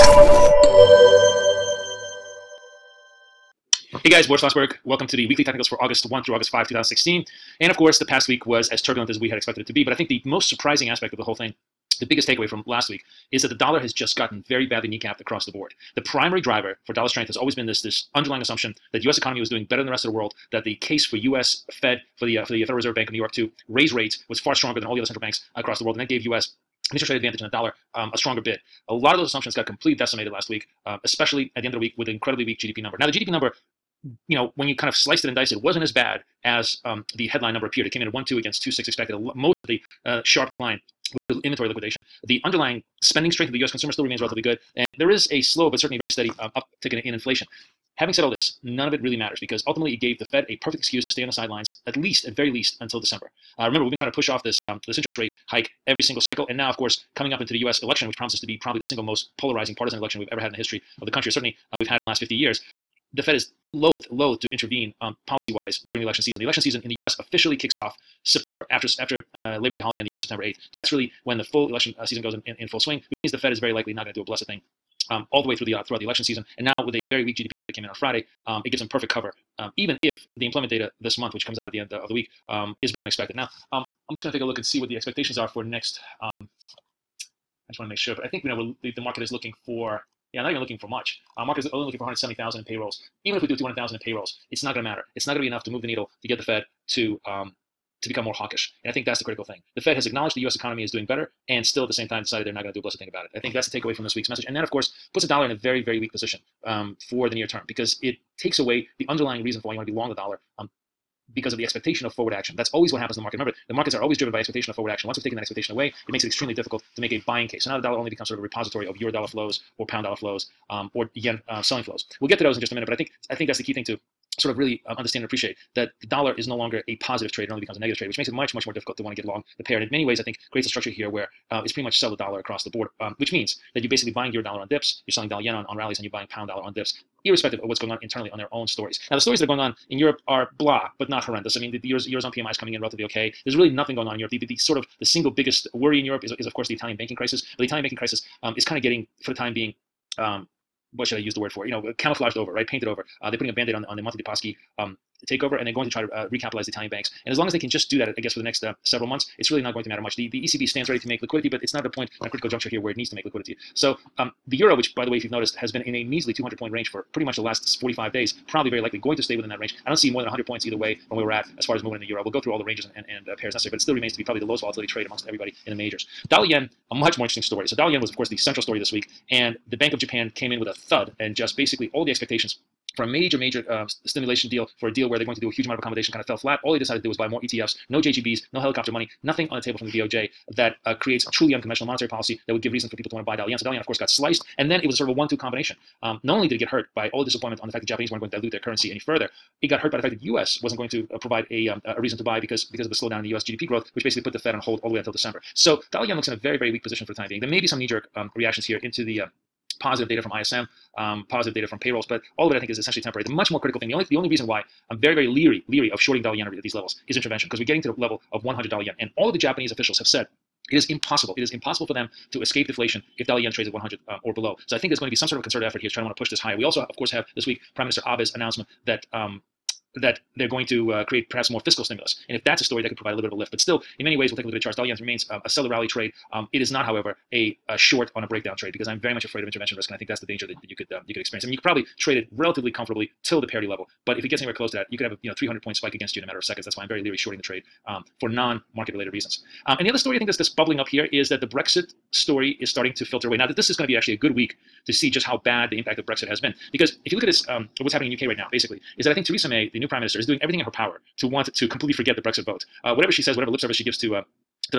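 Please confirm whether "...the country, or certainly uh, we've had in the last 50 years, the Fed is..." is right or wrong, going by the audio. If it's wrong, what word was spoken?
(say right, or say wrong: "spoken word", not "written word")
right.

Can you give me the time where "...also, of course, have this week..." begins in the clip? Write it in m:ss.
3:46.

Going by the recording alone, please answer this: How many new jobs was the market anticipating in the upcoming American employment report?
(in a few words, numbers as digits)
170,000.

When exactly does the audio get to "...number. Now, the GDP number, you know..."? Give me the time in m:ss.
0:32.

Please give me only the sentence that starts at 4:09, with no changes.
Um, and the other story I think that's bubbling up here is that the Brexit story is starting to filter away.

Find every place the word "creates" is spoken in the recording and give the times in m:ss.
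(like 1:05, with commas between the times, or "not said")
2:10, 3:10, 3:51.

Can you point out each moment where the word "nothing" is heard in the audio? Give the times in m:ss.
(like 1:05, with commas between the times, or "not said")
2:23, 3:09.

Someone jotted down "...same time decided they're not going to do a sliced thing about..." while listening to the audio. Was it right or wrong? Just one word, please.
wrong.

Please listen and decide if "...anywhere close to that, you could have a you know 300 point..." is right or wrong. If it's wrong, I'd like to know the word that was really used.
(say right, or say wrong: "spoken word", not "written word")
right.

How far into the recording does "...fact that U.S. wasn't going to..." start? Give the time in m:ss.
3:20.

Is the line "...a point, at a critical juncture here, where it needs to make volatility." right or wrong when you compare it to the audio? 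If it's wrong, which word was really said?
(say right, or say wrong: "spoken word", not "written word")
wrong: "liquidity", not "volatility".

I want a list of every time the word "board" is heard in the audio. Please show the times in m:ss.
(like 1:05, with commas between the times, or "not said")
0:15, 2:12.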